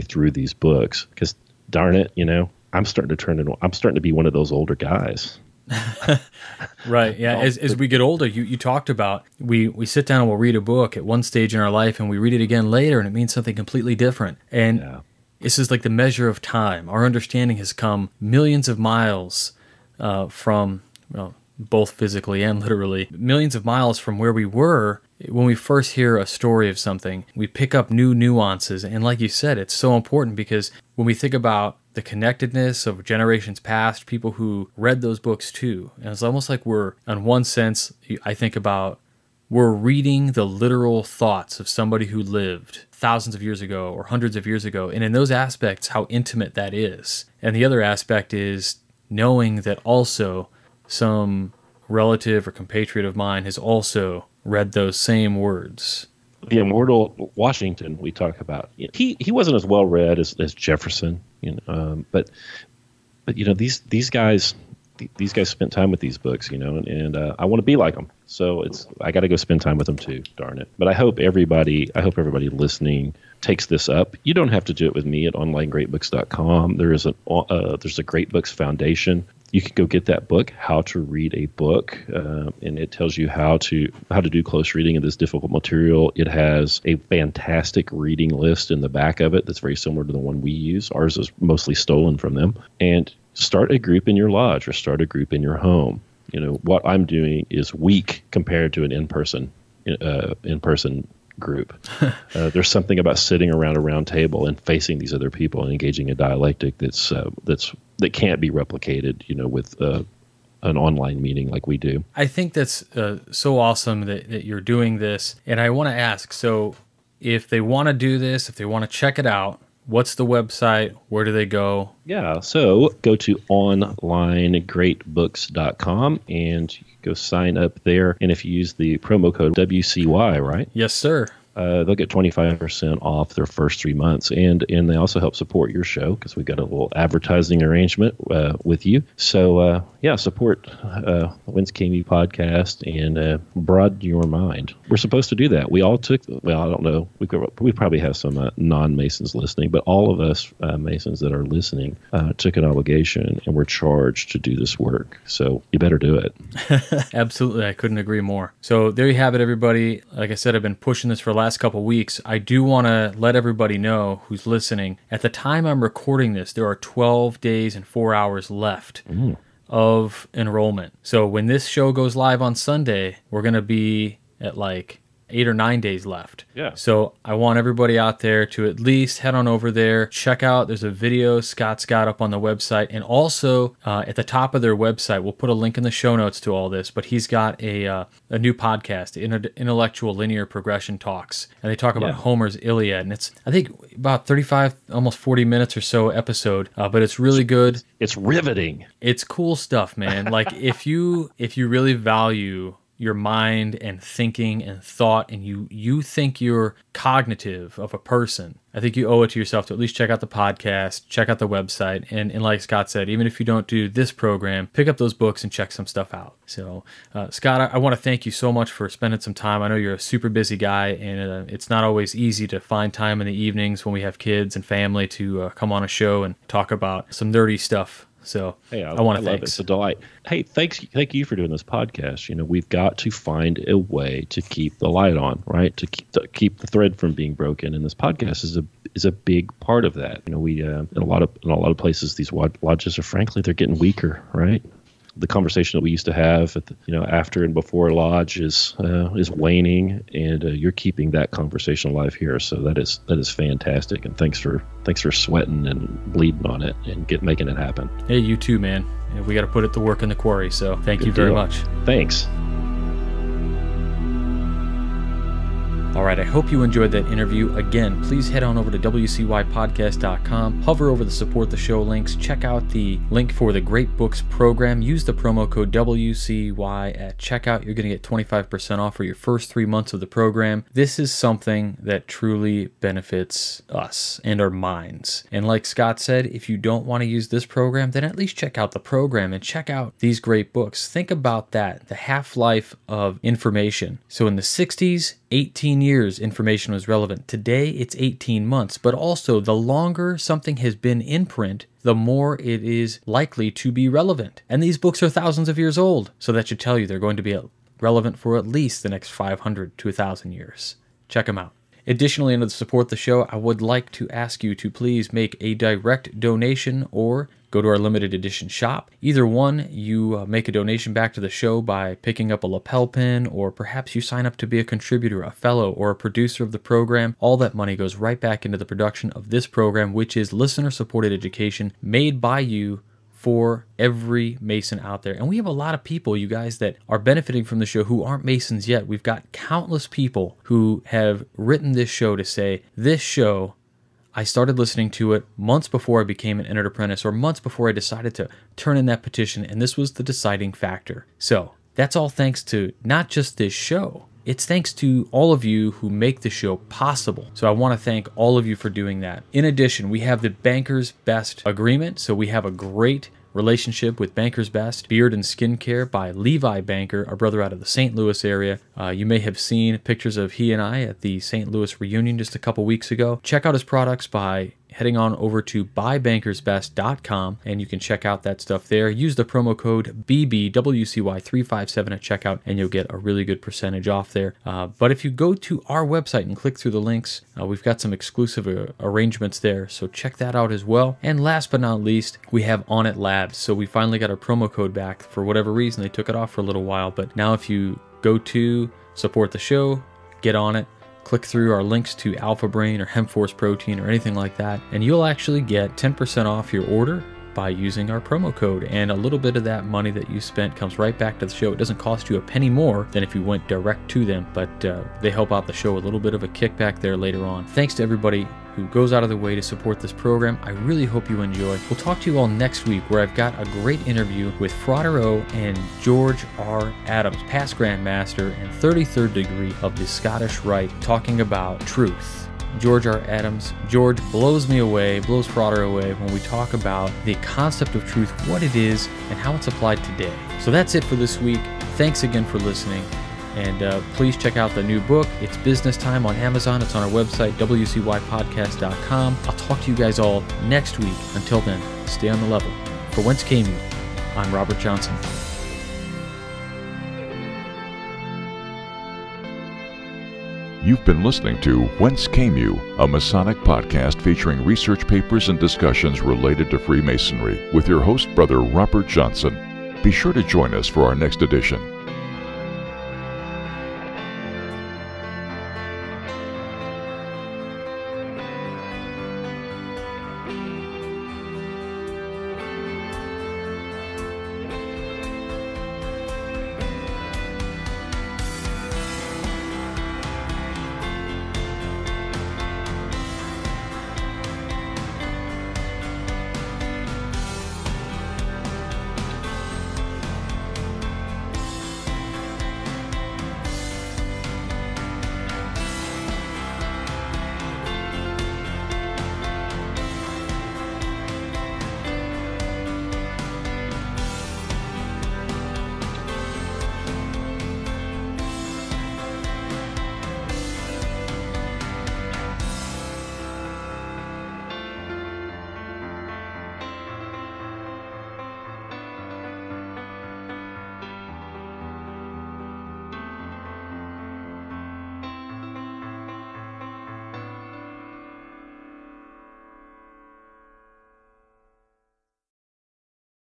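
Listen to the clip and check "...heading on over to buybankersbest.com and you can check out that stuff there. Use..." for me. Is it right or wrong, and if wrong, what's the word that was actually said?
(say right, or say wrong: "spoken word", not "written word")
right.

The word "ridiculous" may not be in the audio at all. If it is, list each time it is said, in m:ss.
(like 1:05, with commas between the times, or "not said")
not said.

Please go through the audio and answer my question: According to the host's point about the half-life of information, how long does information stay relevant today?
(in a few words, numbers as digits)
18 months.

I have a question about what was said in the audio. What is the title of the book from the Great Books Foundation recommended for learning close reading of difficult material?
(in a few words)
How to Read a Book.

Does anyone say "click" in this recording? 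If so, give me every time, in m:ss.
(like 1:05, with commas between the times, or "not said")
6:26, 6:41.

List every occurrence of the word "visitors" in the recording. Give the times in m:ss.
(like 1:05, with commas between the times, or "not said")
not said.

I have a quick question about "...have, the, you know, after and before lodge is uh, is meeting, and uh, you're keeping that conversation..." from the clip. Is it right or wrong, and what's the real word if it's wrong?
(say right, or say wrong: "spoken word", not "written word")
wrong: "waning", not "meeting".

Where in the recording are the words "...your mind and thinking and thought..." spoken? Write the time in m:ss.
3:22.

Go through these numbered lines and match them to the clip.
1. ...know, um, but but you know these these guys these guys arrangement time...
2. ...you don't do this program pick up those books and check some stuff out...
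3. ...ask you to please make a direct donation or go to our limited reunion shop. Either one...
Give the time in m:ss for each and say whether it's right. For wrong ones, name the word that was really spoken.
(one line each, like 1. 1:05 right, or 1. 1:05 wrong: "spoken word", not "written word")
1. 1:01 wrong: "spent", not "arrangement"
2. 3:33 right
3. 5:14 wrong: "edition", not "reunion".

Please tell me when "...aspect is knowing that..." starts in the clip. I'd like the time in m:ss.
0:47.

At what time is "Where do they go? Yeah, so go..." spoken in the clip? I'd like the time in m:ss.
2:01.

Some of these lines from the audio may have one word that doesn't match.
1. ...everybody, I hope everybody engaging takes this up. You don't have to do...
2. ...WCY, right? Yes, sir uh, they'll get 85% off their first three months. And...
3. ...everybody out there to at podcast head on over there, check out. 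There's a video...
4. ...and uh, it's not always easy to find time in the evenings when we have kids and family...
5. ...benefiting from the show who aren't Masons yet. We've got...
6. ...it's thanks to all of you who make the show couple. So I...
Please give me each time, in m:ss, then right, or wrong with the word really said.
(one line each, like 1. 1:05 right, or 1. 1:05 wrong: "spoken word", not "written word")
1. 1:11 wrong: "listening", not "engaging"
2. 2:09 wrong: "25", not "85"
3. 2:57 wrong: "least", not "podcast"
4. 3:40 right
5. 5:36 right
6. 5:54 wrong: "possible", not "couple".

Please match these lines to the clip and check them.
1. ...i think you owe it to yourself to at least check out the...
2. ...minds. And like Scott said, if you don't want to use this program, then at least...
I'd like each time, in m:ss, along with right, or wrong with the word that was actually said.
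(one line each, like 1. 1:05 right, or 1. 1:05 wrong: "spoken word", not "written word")
1. 3:28 right
2. 4:44 right.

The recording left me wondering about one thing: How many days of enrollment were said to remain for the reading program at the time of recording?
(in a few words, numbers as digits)
12.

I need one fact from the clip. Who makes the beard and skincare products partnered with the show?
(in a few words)
Levi Banker.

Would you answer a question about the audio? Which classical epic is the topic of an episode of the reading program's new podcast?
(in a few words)
Homer's Iliad.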